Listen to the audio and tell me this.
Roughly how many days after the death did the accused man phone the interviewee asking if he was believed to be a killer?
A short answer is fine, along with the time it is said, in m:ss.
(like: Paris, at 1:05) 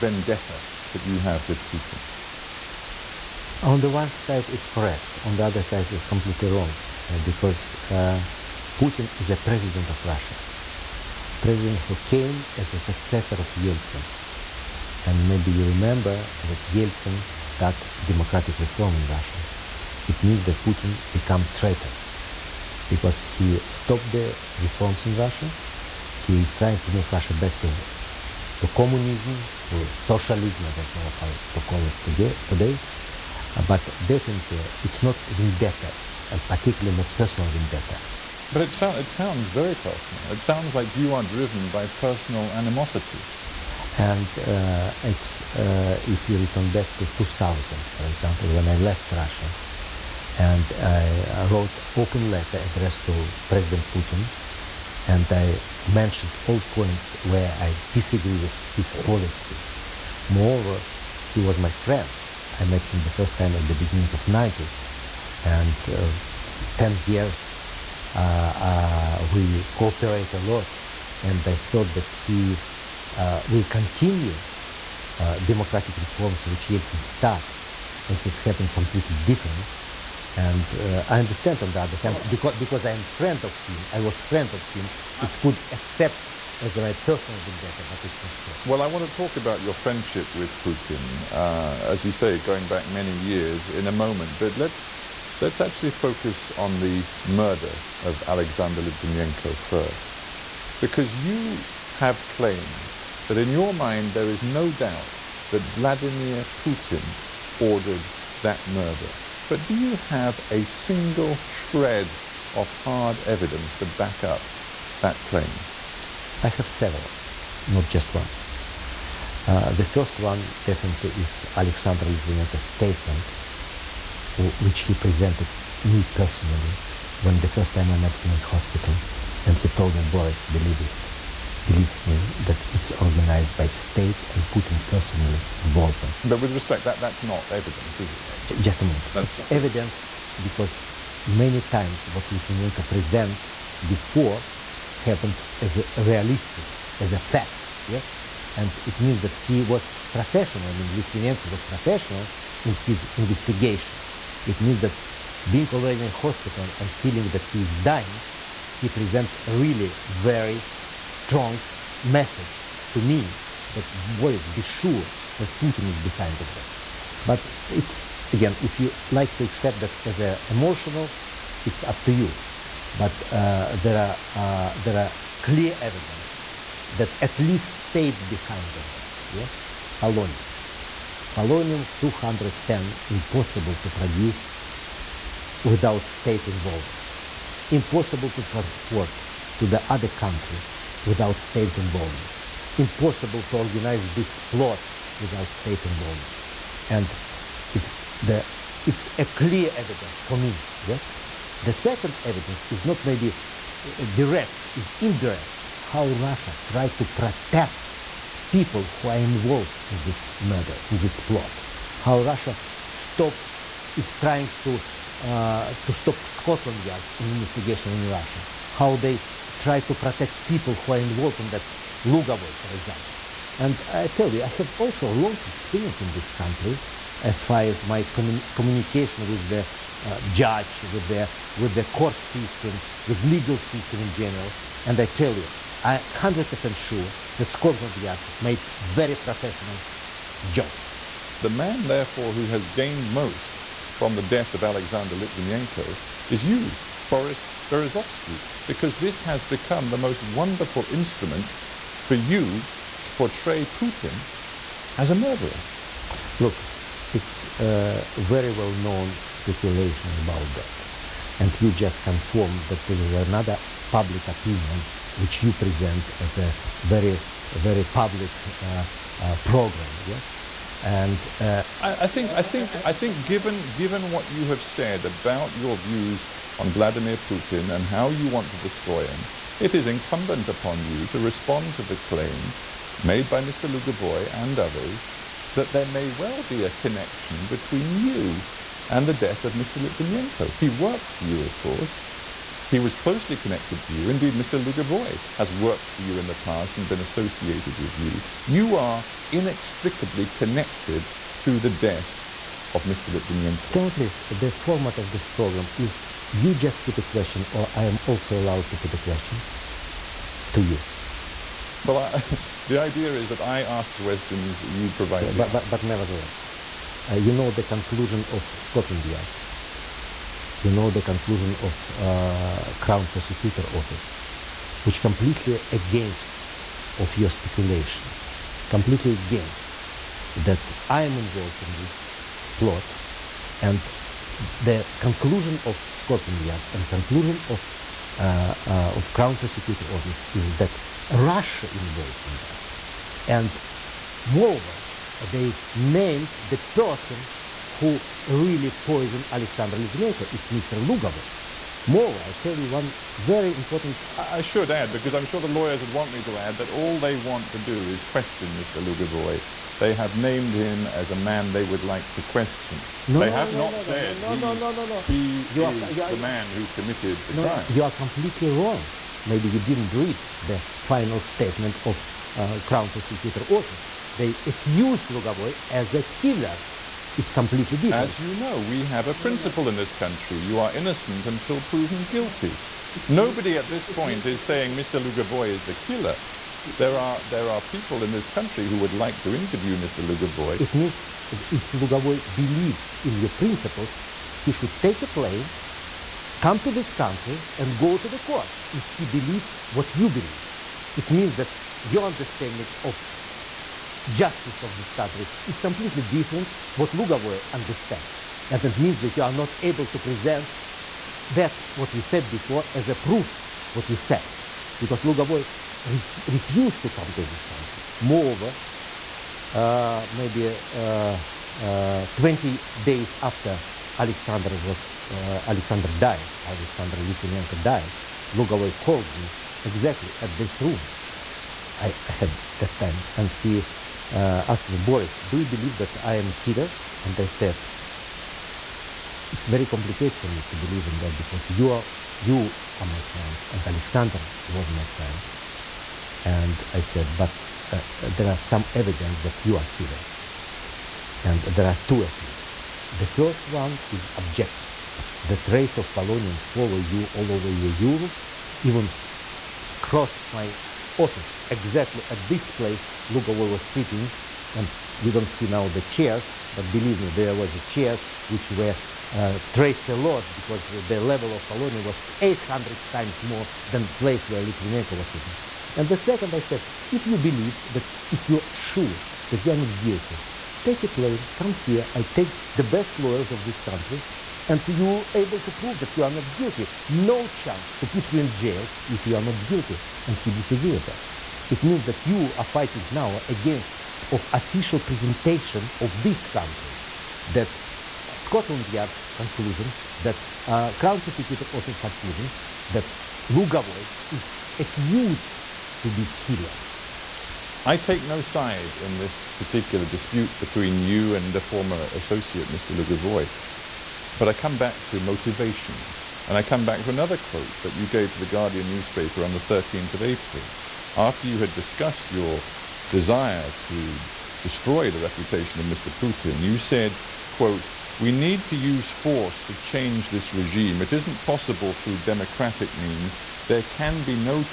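20, at 7:02.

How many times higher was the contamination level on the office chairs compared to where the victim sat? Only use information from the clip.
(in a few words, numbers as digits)
800.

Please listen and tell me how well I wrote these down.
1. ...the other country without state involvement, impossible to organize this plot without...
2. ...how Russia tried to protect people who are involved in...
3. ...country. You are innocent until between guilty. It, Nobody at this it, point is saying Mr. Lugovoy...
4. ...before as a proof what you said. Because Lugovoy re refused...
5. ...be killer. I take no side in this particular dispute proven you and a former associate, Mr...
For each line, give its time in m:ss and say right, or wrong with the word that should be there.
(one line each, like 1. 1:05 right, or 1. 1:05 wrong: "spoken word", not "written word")
1. 3:09 right
2. 3:25 right
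3. 6:19 wrong: "proven", not "between"
4. 6:52 right
5. 8:25 wrong: "between", not "proven".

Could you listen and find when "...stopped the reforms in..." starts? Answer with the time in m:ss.
0:23.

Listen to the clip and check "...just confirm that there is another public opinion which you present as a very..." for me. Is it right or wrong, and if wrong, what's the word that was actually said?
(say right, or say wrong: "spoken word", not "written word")
right.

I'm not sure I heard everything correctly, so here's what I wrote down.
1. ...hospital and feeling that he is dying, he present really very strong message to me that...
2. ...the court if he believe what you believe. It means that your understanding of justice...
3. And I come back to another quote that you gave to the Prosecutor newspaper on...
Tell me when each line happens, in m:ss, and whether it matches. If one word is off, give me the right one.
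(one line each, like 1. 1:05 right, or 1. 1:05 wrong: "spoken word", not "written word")
1. 2:36 right
2. 6:38 right
3. 8:36 wrong: "Guardian", not "Prosecutor".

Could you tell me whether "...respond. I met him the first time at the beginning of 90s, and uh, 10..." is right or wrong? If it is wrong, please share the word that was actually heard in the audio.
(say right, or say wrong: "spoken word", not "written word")
wrong: "friend", not "respond".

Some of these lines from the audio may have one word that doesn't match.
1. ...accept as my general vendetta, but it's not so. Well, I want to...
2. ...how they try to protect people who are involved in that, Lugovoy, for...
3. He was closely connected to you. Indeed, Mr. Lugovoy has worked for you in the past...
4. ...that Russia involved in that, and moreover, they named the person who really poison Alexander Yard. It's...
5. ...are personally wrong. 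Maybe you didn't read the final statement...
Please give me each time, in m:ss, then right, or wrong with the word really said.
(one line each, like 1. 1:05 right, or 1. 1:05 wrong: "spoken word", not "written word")
1. 1:25 wrong: "personal", not "general"
2. 3:38 right
3. 4:52 right
4. 5:40 wrong: "Litvinenko", not "Yard"
5. 6:07 wrong: "completely", not "personally".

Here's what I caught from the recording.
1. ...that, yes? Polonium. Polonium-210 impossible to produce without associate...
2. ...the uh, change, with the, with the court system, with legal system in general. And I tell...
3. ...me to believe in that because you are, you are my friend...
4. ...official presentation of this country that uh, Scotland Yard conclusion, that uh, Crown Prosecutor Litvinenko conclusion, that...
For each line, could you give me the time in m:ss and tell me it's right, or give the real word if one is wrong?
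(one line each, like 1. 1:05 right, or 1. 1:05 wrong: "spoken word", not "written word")
1. 2:58 wrong: "state", not "associate"
2. 3:49 wrong: "judge", not "change"
3. 7:20 right
4. 8:14 wrong: "Office", not "Litvinenko".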